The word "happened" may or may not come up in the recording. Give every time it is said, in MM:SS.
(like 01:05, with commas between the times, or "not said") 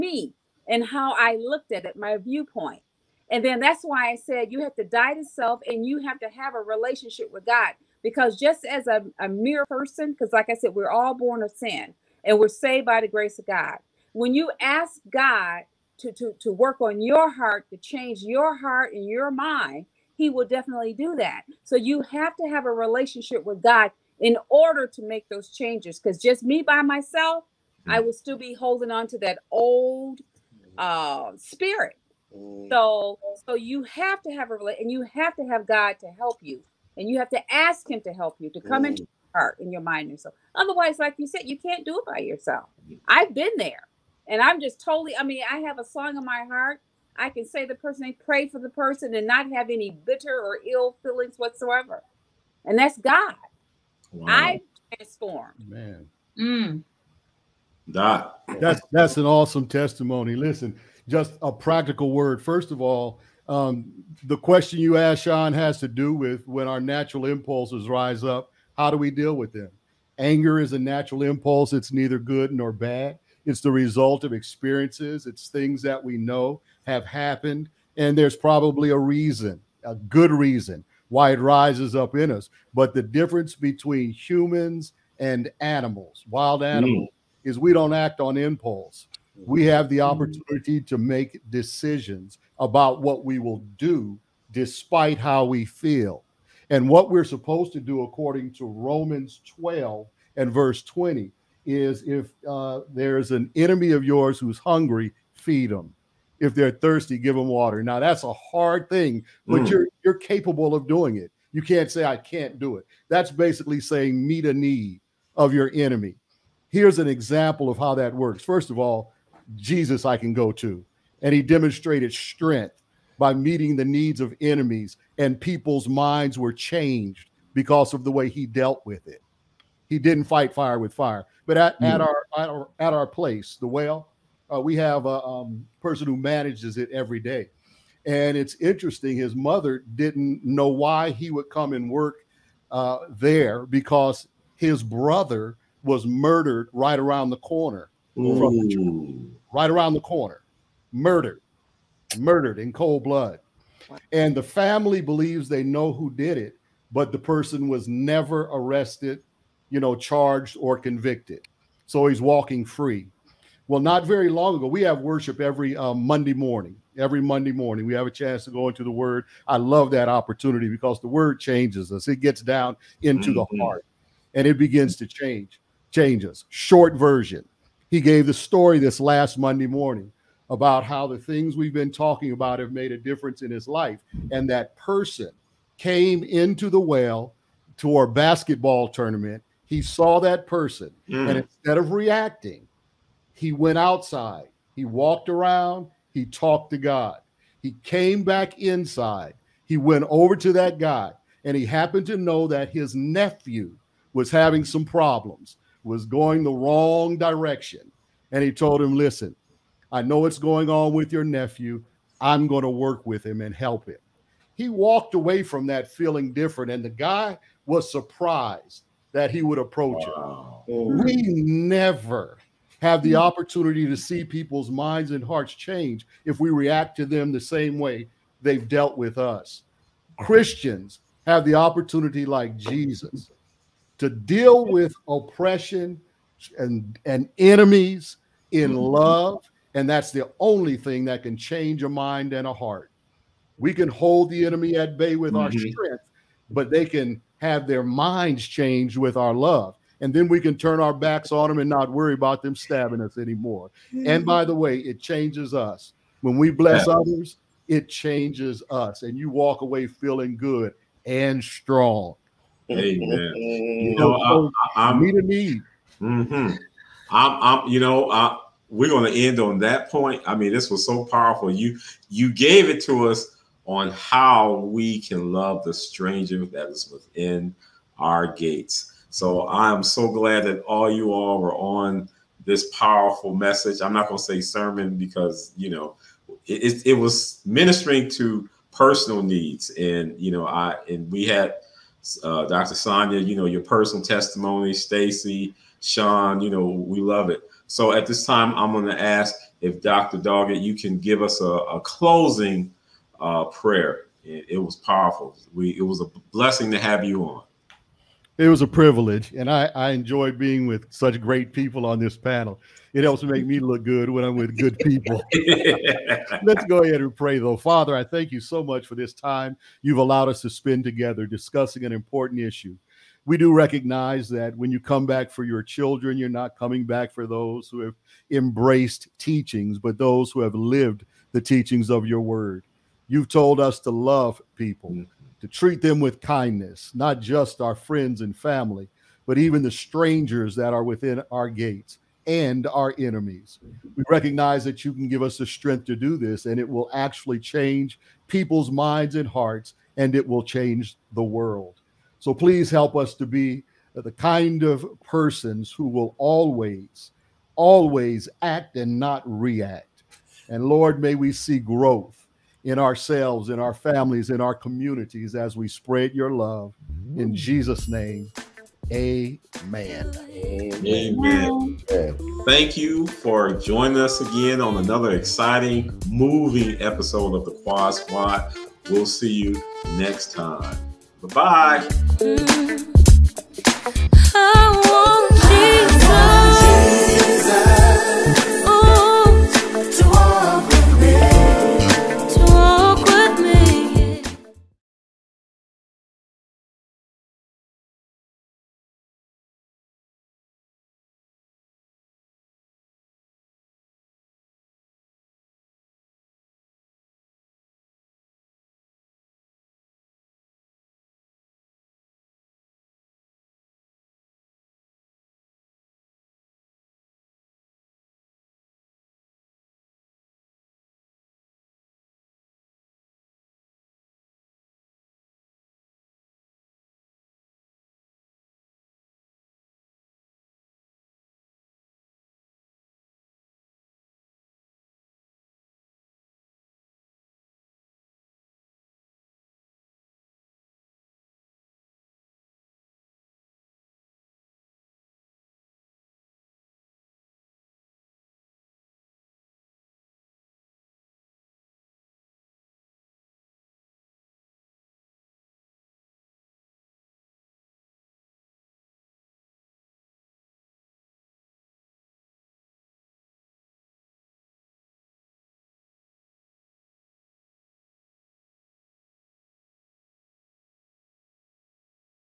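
01:17, 03:21.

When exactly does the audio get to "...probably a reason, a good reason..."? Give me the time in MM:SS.
01:18.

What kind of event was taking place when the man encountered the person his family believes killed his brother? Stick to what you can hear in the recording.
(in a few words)
basketball tournament.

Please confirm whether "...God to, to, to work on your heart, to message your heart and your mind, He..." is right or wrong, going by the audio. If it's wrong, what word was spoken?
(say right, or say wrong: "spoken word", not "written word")
wrong: "change", not "message".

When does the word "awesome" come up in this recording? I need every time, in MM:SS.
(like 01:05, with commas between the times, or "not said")
00:59.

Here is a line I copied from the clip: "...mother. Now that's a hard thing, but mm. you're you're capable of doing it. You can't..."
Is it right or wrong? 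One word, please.
wrong.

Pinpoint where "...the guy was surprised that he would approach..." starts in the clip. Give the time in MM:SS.
03:36.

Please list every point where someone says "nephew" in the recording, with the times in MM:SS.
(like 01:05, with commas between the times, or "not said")
03:22, 03:31.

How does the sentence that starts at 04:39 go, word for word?
So I'm so glad that all you all were on this powerful message.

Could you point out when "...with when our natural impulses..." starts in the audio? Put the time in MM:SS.
01:06.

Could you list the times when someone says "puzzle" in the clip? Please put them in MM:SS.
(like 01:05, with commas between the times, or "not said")
not said.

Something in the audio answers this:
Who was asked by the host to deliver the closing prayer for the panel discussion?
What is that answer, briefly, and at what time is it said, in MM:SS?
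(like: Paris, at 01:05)
Dr. Doggette, at 04:59.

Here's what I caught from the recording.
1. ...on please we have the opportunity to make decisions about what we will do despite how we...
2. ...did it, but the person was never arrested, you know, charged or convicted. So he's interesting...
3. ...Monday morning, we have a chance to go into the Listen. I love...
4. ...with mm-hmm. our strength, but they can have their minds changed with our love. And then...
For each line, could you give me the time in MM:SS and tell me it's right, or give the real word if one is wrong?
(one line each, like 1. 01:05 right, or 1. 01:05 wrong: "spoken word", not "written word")
1. 01:28 wrong: "impulse", not "please"
2. 02:36 wrong: "walking", not "interesting"
3. 02:47 wrong: "Word", not "Listen"
4. 04:05 right.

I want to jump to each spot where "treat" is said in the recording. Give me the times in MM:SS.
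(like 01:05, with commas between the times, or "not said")
05:35.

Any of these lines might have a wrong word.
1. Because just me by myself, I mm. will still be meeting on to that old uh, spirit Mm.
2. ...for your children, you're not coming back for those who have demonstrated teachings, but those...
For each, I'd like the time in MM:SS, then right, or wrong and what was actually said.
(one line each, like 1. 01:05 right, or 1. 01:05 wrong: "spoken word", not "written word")
1. 00:25 wrong: "holding", not "meeting"
2. 05:25 wrong: "embraced", not "demonstrated".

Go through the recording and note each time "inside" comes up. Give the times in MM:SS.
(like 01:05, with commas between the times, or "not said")
03:18.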